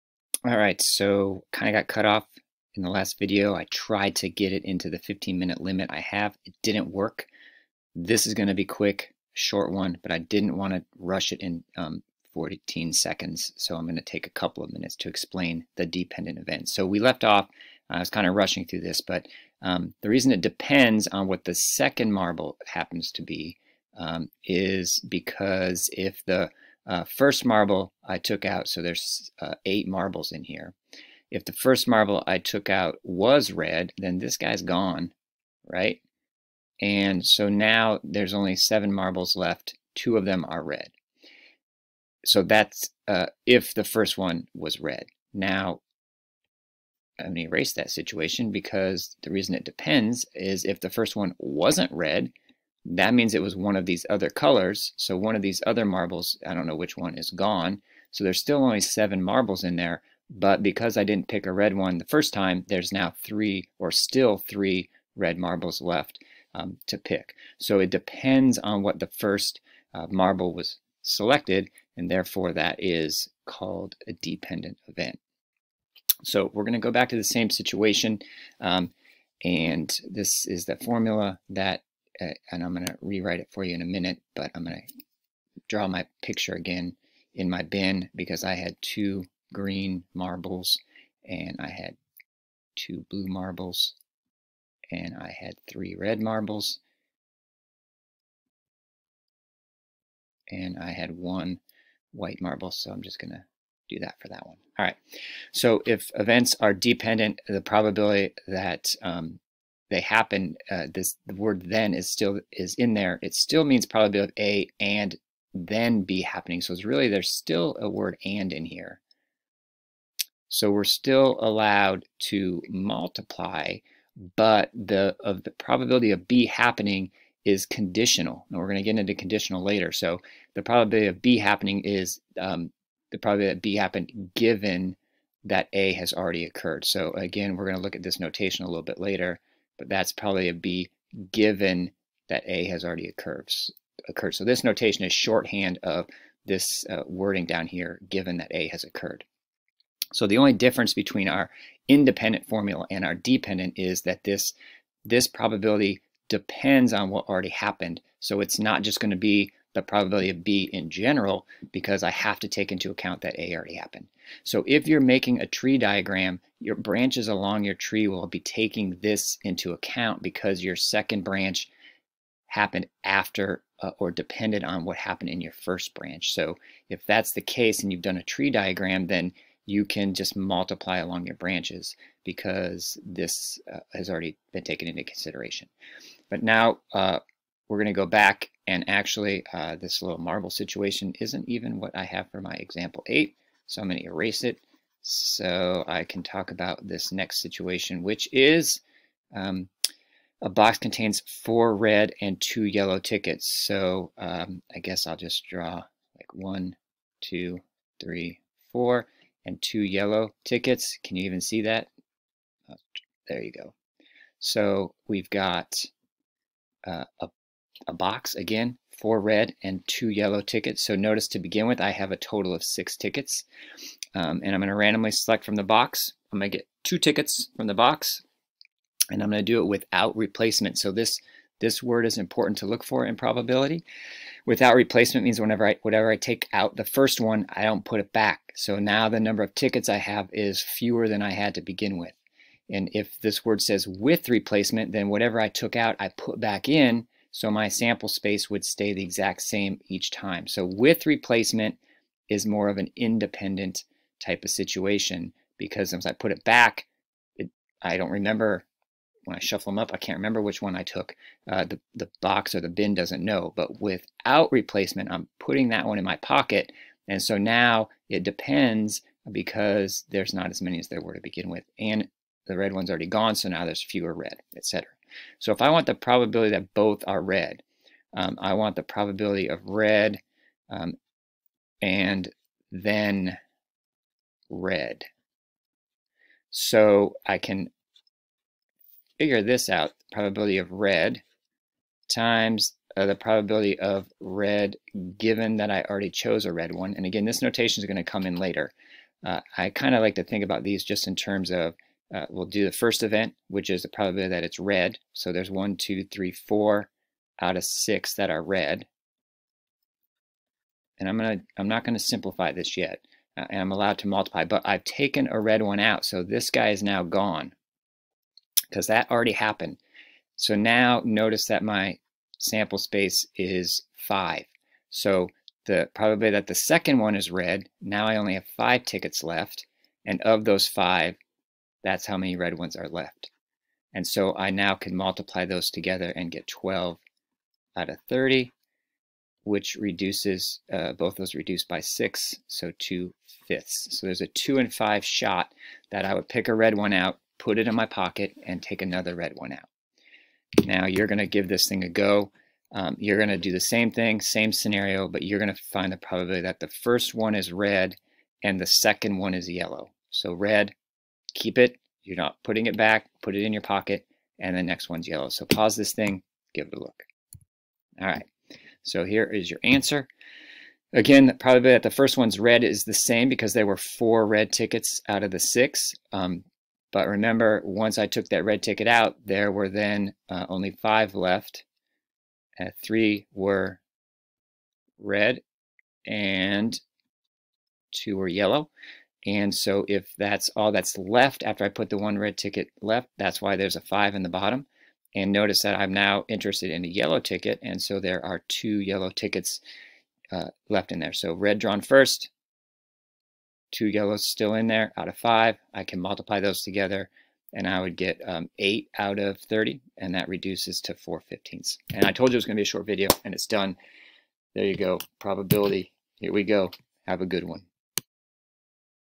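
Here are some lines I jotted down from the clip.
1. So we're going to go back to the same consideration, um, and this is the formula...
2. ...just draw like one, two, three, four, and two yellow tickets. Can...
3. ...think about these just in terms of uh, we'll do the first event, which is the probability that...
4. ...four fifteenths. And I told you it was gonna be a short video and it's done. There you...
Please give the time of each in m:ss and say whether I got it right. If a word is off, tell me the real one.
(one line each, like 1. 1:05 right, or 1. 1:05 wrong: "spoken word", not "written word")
1. 1:16 wrong: "situation", not "consideration"
2. 3:25 right
3. 5:00 right
4. 6:50 right.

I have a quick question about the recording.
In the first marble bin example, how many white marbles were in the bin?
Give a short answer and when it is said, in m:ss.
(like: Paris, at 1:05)
1, at 1:41.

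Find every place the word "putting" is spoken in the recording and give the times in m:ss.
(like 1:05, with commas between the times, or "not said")
4:25, 6:02.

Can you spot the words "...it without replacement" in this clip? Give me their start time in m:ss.
3:49.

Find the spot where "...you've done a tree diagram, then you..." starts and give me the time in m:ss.
2:57.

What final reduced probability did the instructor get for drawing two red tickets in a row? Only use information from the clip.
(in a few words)
2/5.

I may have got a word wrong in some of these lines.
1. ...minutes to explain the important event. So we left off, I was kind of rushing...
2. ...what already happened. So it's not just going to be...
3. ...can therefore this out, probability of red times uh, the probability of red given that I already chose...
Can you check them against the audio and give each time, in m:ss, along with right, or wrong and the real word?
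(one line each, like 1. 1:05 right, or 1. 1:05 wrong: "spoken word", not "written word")
1. 0:14 wrong: "dependent", not "important"
2. 2:37 right
3. 4:47 wrong: "figure", not "therefore".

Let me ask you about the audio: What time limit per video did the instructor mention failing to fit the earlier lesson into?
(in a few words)
15 minutes.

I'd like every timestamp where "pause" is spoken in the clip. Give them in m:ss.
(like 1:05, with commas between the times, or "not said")
6:05.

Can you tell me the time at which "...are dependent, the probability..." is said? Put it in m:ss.
1:46.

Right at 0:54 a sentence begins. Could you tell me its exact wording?
So one of these other marbles, I don't know which one, is gone.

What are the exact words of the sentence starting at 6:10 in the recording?
Again, probably that the first one's red is the same because there were four red tickets out of the six.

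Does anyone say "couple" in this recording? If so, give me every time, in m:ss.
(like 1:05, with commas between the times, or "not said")
0:14.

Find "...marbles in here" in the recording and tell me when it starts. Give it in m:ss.
0:29.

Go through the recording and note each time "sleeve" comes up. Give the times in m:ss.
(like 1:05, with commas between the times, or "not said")
not said.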